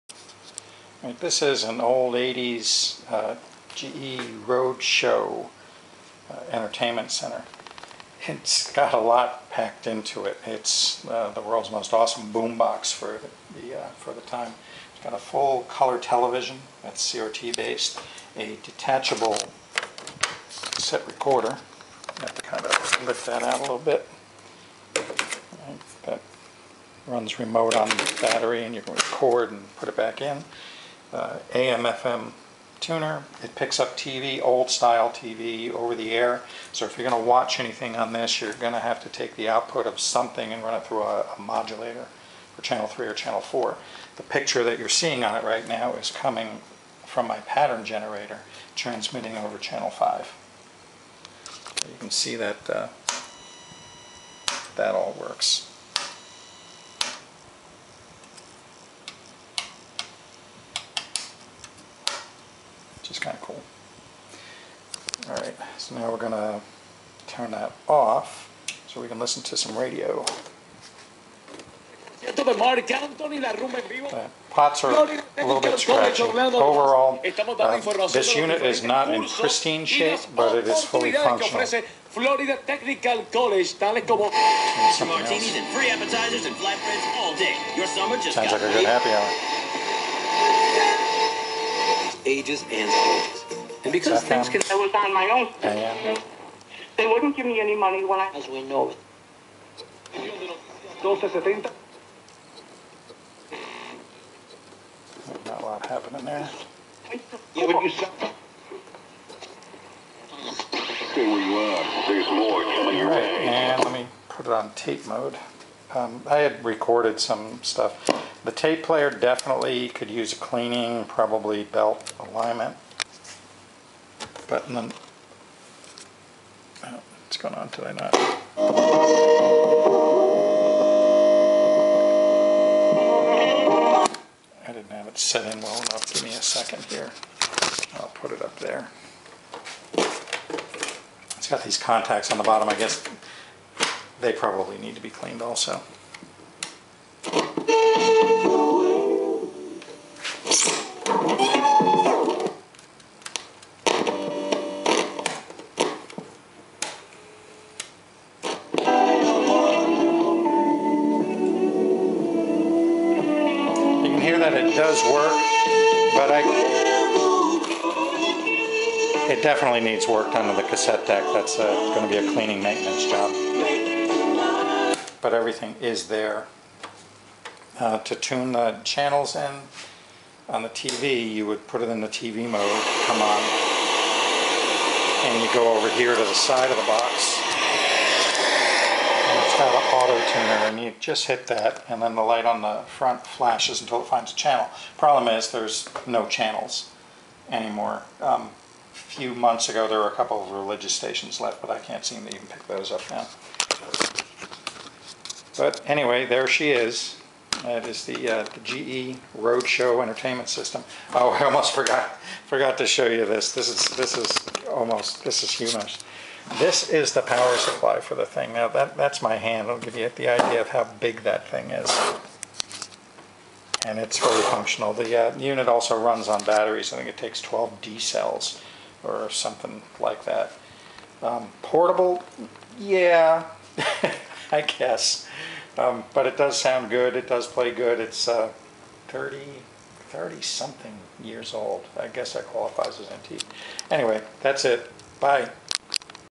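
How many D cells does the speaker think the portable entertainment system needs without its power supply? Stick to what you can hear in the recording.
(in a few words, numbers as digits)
12.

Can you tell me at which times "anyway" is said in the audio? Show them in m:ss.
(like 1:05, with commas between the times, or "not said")
3:25, 4:03.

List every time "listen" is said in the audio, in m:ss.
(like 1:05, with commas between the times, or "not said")
1:09.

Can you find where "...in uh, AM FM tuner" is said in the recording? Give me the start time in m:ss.
0:30.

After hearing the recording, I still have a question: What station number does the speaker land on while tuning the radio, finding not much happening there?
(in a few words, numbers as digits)
1270.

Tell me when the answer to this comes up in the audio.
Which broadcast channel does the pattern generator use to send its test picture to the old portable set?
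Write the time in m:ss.
0:49.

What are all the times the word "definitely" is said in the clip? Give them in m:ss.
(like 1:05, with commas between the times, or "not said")
1:59, 2:49.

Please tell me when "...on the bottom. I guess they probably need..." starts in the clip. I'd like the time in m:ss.
2:22.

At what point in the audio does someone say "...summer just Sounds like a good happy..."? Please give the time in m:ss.
1:27.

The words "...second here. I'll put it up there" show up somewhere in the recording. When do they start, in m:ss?
2:16.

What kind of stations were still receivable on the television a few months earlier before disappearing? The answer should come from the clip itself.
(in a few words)
Religious stations.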